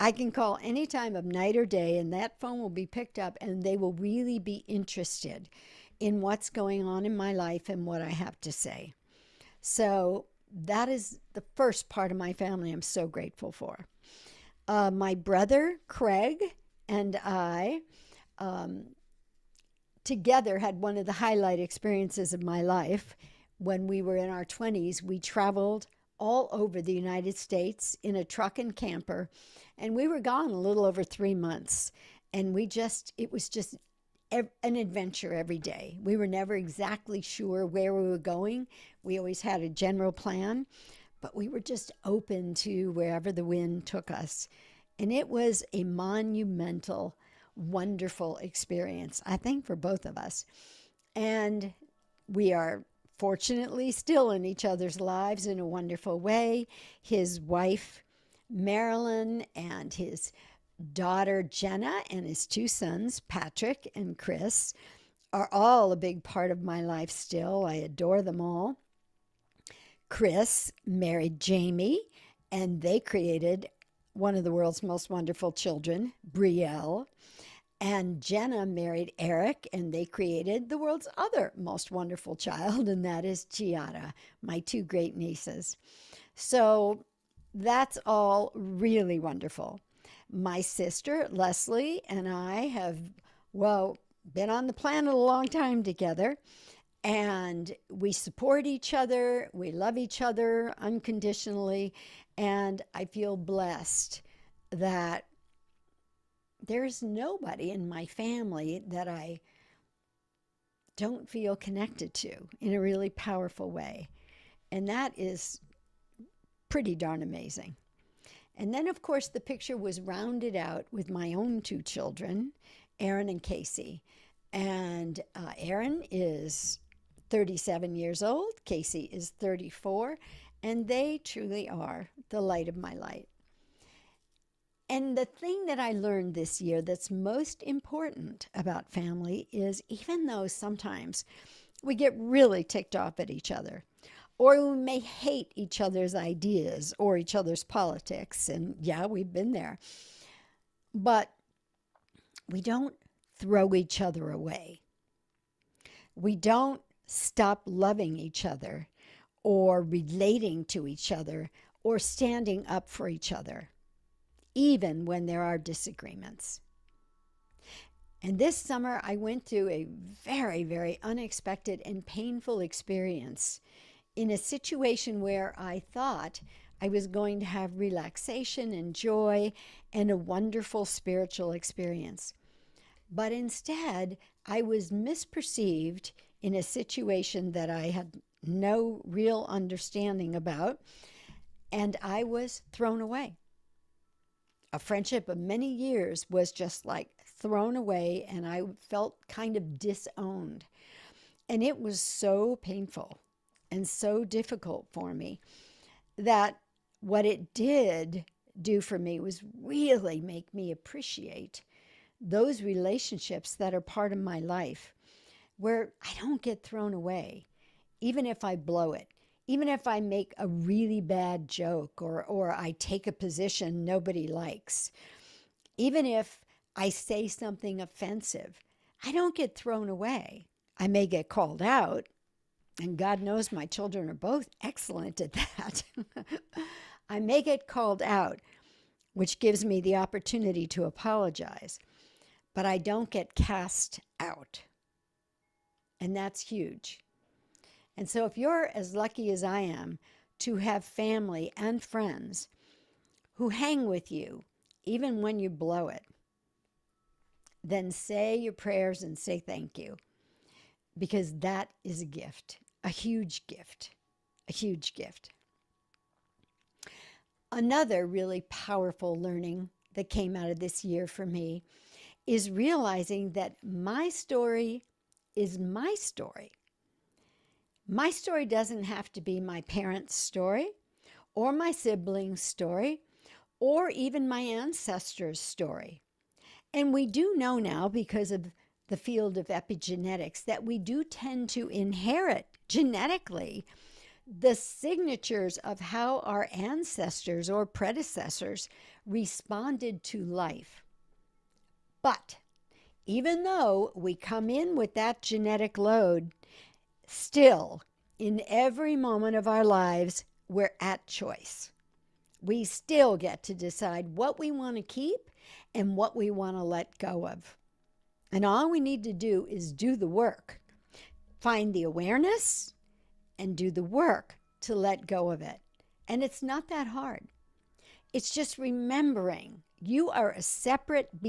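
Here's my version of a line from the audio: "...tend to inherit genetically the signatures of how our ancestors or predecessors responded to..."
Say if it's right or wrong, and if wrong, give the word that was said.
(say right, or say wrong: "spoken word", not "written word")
right.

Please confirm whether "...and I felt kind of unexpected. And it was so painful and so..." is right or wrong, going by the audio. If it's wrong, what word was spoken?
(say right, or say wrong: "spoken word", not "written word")
wrong: "disowned", not "unexpected".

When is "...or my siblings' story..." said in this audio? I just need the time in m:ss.
4:41.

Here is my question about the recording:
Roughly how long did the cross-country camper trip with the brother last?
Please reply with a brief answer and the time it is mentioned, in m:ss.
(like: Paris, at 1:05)
a little over three months, at 0:30.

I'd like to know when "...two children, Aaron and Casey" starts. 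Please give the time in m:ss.
2:01.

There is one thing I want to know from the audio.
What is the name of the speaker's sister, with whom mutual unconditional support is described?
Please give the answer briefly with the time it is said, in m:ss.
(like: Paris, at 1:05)
Leslie, at 1:31.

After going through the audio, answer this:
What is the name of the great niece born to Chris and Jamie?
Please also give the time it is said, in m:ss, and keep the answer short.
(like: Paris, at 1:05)
Brielle, at 1:16.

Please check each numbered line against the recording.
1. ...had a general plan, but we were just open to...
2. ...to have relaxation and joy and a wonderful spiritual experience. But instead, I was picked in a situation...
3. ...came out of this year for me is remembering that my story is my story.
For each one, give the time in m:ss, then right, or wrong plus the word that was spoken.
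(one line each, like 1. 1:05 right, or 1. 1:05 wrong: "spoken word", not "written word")
1. 0:39 right
2. 2:57 wrong: "misperceived", not "picked"
3. 4:30 wrong: "realizing", not "remembering".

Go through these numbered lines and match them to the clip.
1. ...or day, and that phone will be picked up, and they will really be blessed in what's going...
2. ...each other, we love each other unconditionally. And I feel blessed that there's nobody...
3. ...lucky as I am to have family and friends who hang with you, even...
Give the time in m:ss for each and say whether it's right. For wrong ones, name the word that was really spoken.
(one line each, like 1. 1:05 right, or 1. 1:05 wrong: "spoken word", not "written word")
1. 0:01 wrong: "interested", not "blessed"
2. 1:38 right
3. 4:08 right.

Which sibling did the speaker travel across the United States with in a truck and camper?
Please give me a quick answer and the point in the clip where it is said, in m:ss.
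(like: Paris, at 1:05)
Craig, at 0:15.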